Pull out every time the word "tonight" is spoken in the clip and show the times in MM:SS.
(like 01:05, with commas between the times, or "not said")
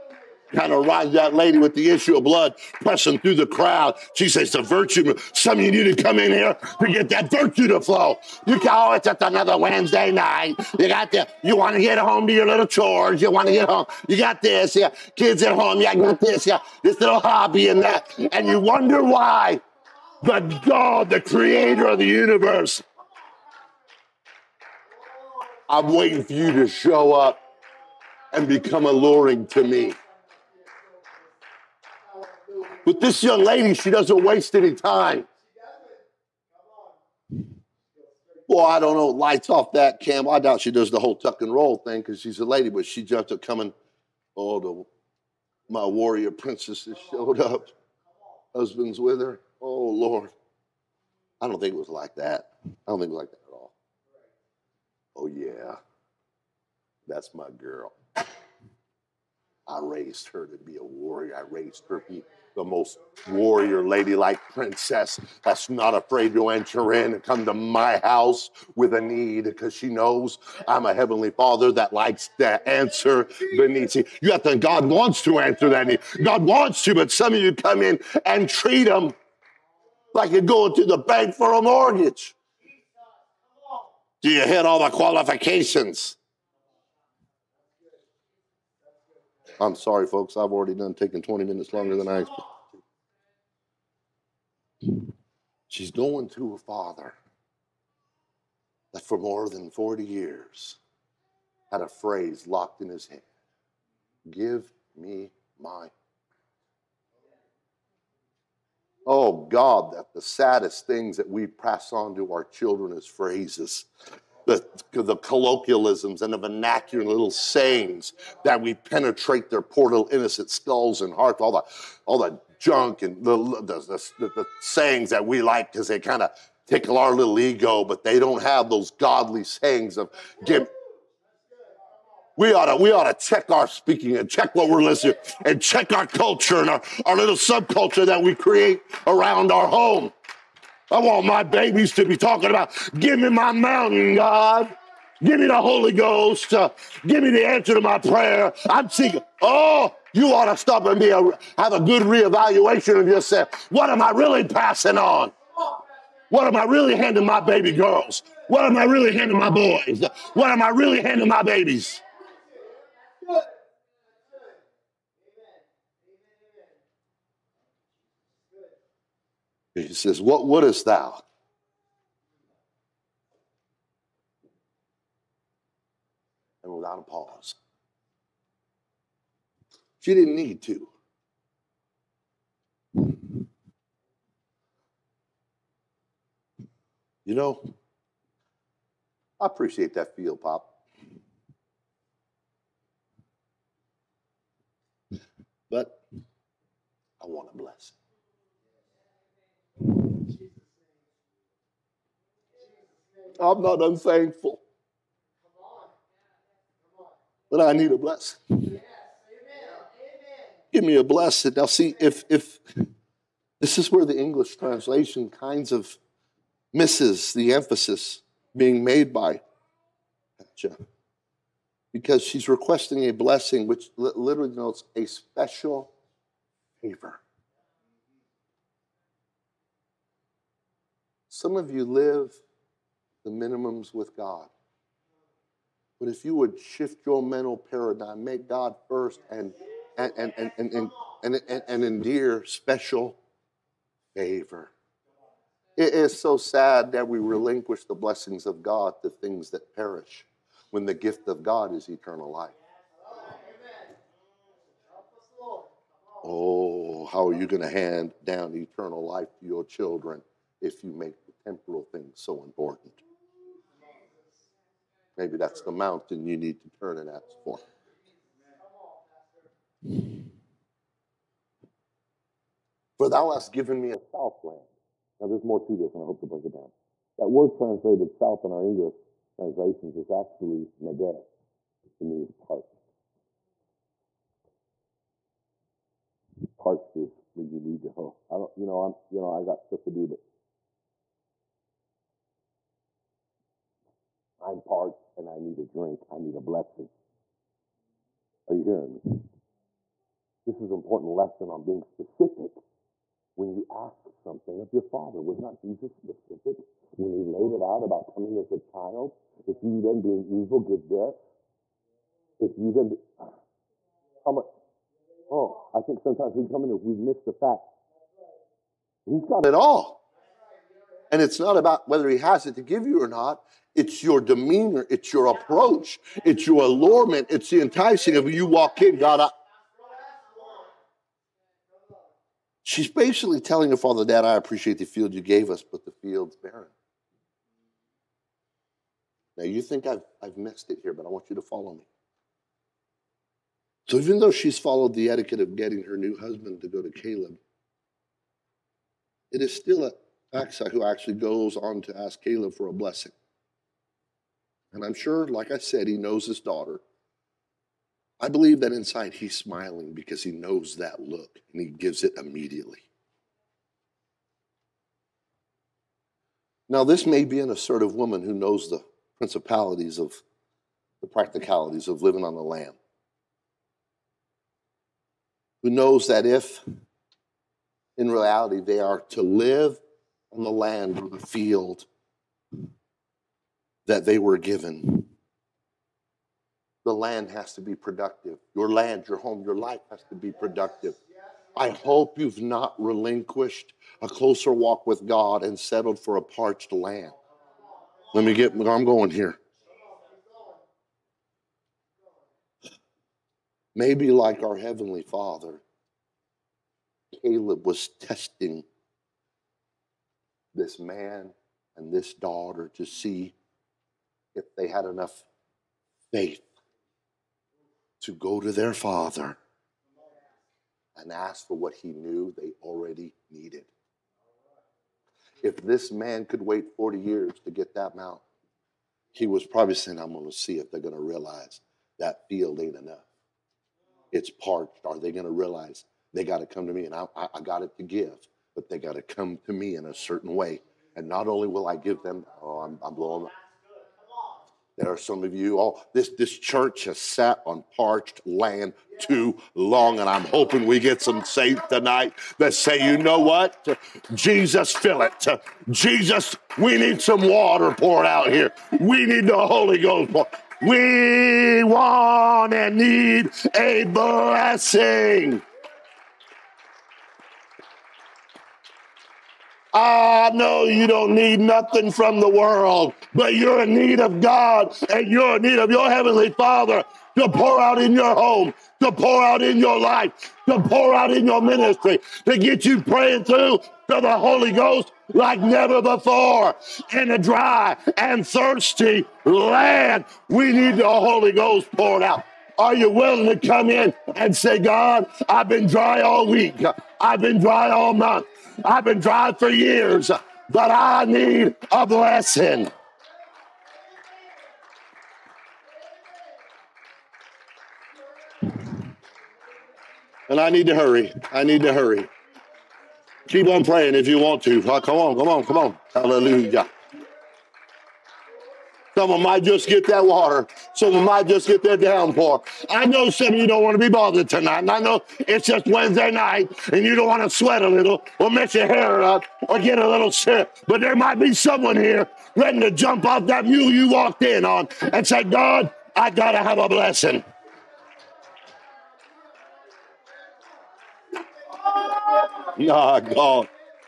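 07:31, 08:44.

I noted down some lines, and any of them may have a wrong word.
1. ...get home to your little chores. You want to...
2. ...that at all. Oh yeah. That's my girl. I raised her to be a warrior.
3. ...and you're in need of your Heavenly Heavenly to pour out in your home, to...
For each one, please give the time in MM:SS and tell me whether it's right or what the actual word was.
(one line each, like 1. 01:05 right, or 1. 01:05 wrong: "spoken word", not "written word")
1. 00:11 right
2. 00:53 right
3. 07:54 wrong: "Father", not "Heavenly".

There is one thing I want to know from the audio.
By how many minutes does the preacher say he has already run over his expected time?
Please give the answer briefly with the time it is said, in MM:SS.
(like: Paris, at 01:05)
20, at 01:31.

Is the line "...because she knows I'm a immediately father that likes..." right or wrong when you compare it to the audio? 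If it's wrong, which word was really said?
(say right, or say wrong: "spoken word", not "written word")
wrong: "heavenly", not "immediately".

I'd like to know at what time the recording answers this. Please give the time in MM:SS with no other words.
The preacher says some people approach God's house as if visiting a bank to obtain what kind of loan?
01:21.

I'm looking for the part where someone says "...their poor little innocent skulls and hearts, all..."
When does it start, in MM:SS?
01:59.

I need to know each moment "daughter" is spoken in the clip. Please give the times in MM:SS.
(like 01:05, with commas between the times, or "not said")
05:56, 06:52.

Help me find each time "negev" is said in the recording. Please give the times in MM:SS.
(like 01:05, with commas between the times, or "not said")
04:40.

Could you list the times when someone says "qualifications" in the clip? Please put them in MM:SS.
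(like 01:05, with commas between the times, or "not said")
01:24.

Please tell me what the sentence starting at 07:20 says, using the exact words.
And not only will I give them, oh, I'm, I'm blowing up.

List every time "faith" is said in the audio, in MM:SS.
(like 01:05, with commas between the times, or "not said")
06:56.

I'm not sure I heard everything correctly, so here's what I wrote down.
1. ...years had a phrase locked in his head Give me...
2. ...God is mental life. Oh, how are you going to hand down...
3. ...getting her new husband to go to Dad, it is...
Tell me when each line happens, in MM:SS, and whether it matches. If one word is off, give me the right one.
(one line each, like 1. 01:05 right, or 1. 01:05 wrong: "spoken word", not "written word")
1. 01:40 right
2. 04:11 wrong: "eternal", not "mental"
3. 05:45 wrong: "Caleb", not "Dad".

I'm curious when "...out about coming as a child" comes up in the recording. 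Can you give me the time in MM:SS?
05:07.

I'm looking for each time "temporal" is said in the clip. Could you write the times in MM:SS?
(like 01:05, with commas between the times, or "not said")
04:21.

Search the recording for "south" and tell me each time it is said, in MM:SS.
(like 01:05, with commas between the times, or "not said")
04:33, 04:38.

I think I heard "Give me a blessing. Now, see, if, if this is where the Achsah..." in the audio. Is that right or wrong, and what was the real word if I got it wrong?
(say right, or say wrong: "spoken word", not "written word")
wrong: "English", not "Achsah".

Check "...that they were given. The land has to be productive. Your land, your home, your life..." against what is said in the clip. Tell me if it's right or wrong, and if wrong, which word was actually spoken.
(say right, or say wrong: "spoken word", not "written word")
right.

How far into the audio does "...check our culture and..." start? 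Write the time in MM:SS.
02:15.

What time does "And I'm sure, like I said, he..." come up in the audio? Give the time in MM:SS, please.
05:54.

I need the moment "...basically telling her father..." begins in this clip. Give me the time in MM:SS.
05:32.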